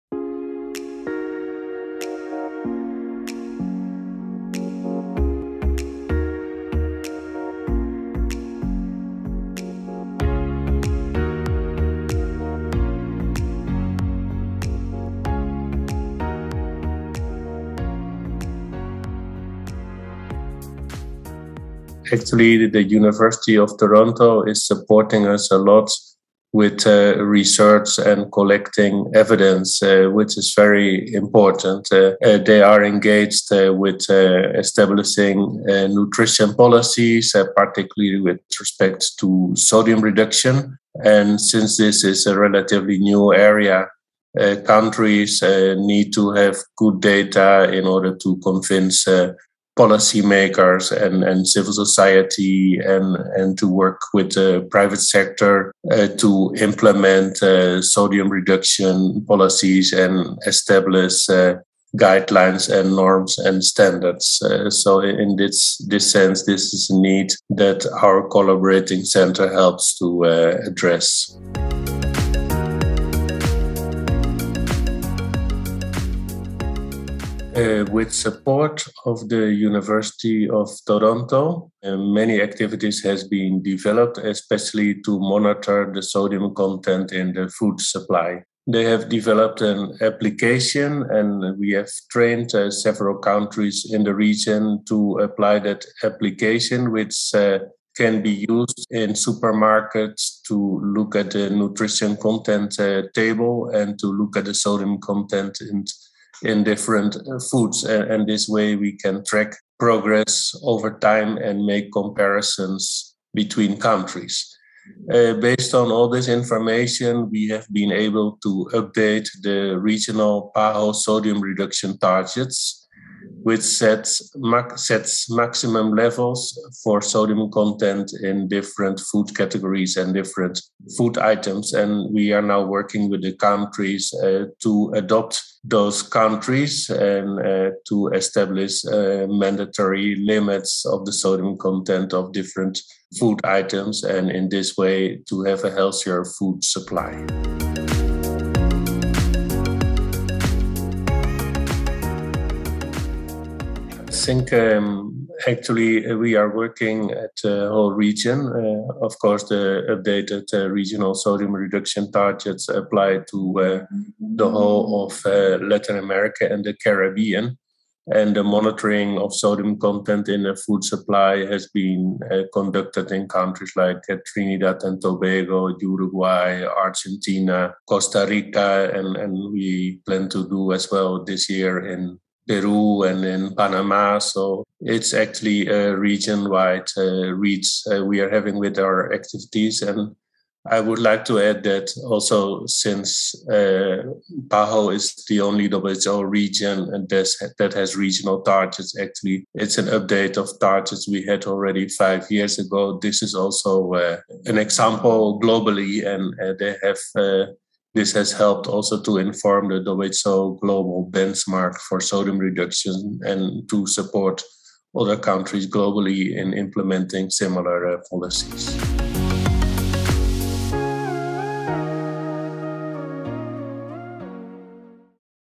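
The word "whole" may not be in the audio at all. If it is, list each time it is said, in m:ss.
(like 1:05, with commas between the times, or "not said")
2:37, 2:44.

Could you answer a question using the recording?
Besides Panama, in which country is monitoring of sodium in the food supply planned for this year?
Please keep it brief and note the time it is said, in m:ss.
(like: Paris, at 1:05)
Peru, at 3:02.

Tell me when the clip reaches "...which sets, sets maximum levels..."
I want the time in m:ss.
2:03.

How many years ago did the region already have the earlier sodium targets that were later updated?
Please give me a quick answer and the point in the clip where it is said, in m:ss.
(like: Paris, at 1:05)
5, at 3:21.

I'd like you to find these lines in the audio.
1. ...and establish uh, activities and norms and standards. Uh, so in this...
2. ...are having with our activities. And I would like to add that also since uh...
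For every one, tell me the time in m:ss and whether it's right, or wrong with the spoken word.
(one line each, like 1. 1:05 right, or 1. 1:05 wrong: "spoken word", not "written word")
1. 0:59 wrong: "guidelines", not "activities"
2. 3:08 right.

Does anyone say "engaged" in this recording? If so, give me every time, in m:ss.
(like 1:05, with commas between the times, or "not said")
0:32.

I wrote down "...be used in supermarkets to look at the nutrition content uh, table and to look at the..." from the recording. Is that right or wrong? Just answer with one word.
right.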